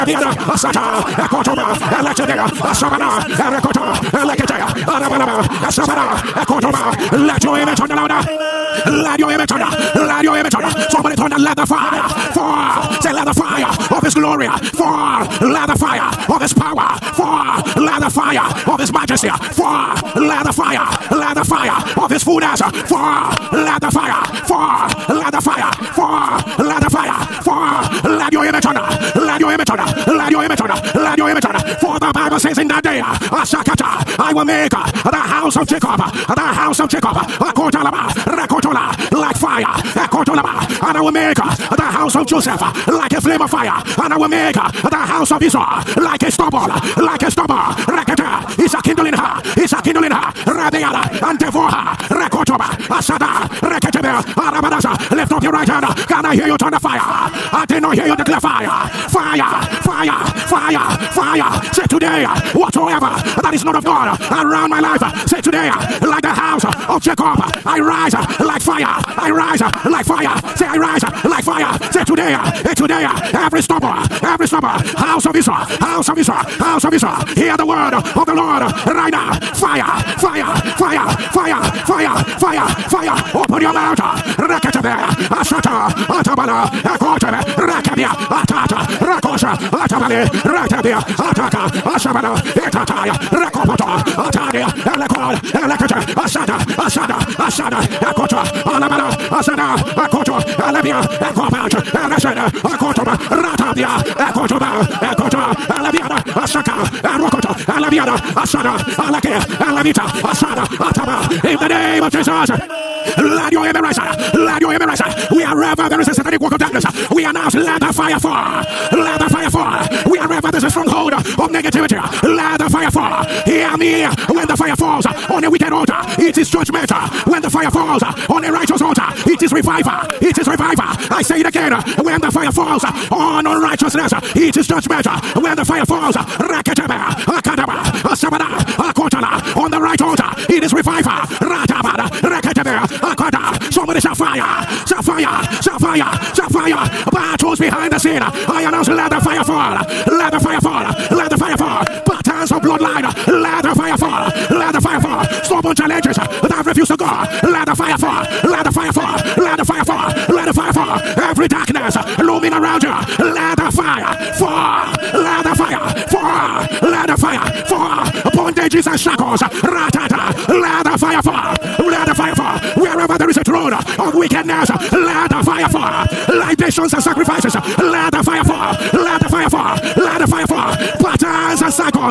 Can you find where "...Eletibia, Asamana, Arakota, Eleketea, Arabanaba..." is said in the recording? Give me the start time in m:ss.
0:01.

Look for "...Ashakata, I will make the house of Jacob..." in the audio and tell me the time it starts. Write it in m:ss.
0:33.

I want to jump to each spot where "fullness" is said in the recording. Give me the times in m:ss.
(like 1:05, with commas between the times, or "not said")
0:22.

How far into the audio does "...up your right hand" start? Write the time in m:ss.
0:55.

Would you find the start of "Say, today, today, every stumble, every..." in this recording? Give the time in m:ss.
1:11.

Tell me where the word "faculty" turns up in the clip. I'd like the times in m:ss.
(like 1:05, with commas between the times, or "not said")
not said.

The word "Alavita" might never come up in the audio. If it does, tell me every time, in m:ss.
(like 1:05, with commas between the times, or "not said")
1:49.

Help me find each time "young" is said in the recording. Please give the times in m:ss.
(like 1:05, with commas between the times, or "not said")
not said.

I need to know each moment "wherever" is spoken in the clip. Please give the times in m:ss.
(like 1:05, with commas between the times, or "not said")
1:55, 2:00, 2:52.